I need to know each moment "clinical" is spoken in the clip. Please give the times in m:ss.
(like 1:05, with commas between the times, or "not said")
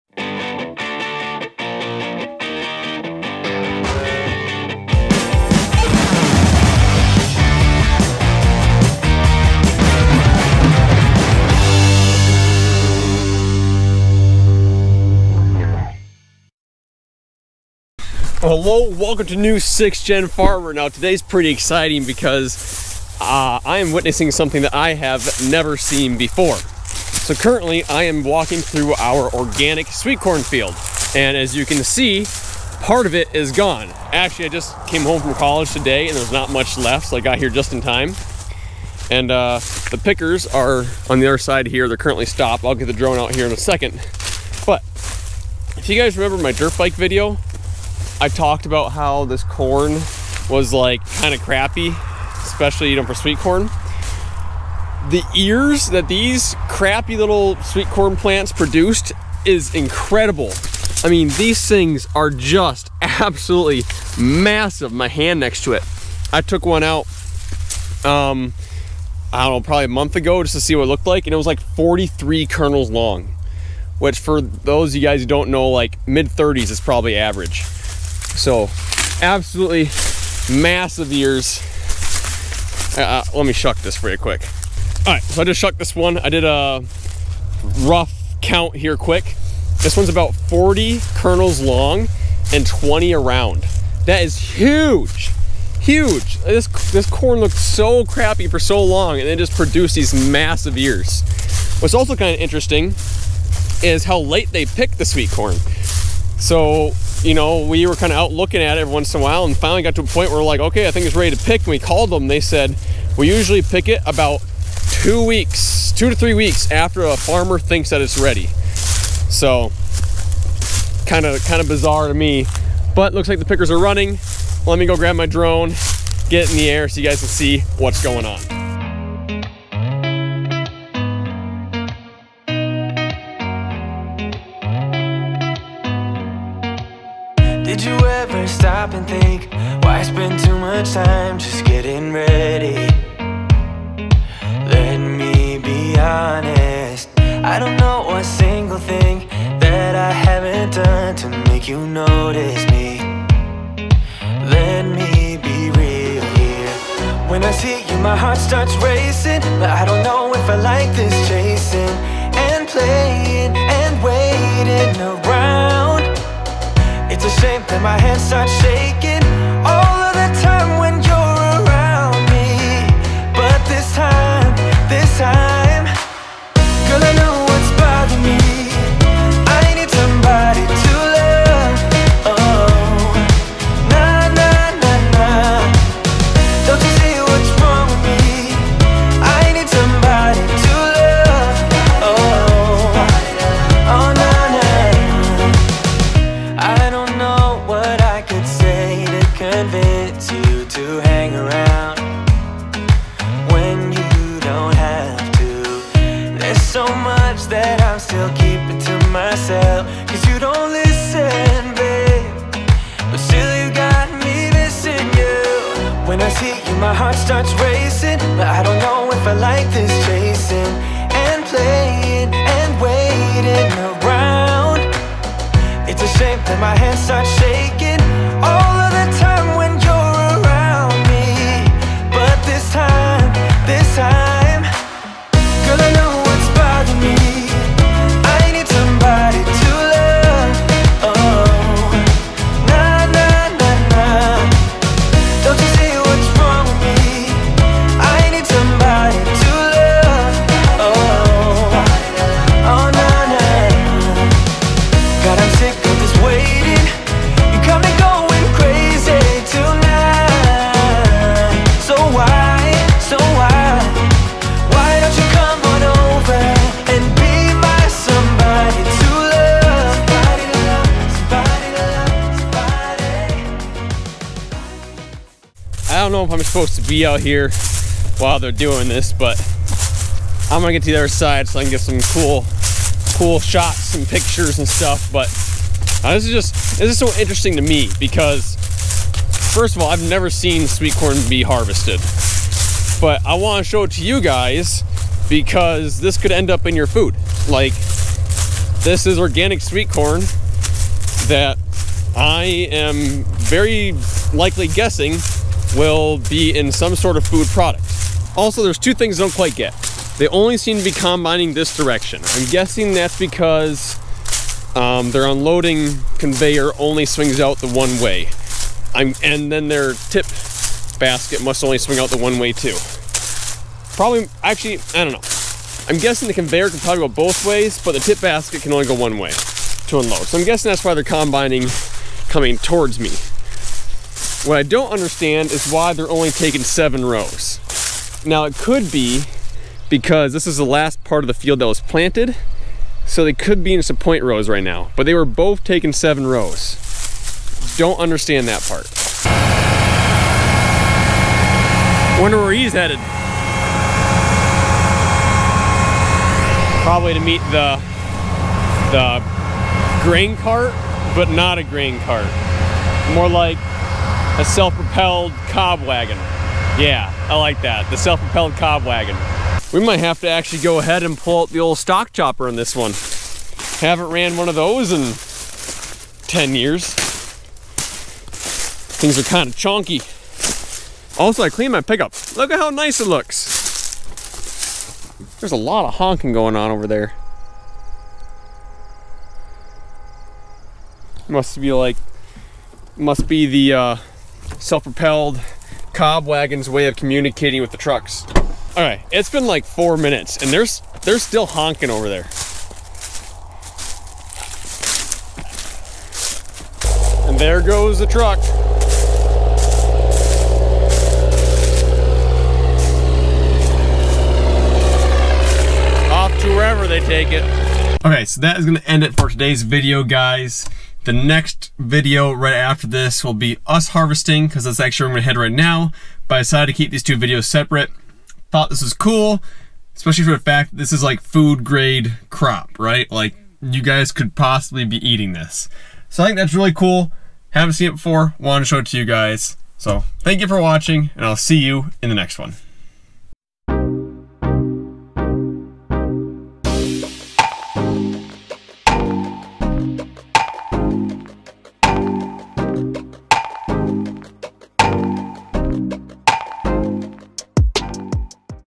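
not said.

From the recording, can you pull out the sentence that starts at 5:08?
Also, there's two things I don't quite get.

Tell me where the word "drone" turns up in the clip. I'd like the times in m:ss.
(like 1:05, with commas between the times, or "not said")
0:42, 2:05.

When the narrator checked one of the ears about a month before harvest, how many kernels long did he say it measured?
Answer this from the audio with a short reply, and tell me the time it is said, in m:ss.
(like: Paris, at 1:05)
43, at 1:11.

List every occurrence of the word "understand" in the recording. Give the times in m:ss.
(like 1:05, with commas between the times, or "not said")
5:34, 5:47.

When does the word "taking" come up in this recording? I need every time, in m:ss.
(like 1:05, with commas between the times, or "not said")
5:36, 5:45.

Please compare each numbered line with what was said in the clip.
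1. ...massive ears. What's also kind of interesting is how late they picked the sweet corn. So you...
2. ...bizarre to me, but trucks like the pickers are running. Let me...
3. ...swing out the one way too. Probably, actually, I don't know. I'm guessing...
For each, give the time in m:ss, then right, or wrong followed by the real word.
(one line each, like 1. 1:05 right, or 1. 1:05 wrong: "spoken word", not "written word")
1. 1:40 right
2. 2:01 wrong: "looks", not "trucks"
3. 5:21 right.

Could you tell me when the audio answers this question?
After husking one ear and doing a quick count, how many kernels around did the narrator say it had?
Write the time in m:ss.
1:32.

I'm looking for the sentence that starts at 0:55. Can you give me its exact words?
The ears that these crappy little sweet corn plants produced is incredible.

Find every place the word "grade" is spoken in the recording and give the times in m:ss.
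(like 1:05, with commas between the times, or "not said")
7:11.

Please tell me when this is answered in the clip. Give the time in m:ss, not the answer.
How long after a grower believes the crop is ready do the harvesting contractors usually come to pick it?
1:55.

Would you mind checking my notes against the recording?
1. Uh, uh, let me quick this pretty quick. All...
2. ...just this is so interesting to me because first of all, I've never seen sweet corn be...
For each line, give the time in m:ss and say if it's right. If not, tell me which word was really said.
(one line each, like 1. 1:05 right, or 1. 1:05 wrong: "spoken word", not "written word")
1. 1:22 wrong: "shuck", not "quick"
2. 4:46 right.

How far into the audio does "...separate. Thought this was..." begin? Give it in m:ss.
7:07.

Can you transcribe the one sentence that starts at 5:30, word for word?
So I'm guessing that's why they're combining coming towards me.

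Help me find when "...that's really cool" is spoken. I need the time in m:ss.
7:16.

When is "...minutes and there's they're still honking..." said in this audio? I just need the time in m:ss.
6:39.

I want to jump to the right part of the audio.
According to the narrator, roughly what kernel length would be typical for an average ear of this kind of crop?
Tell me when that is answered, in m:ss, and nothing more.
1:16.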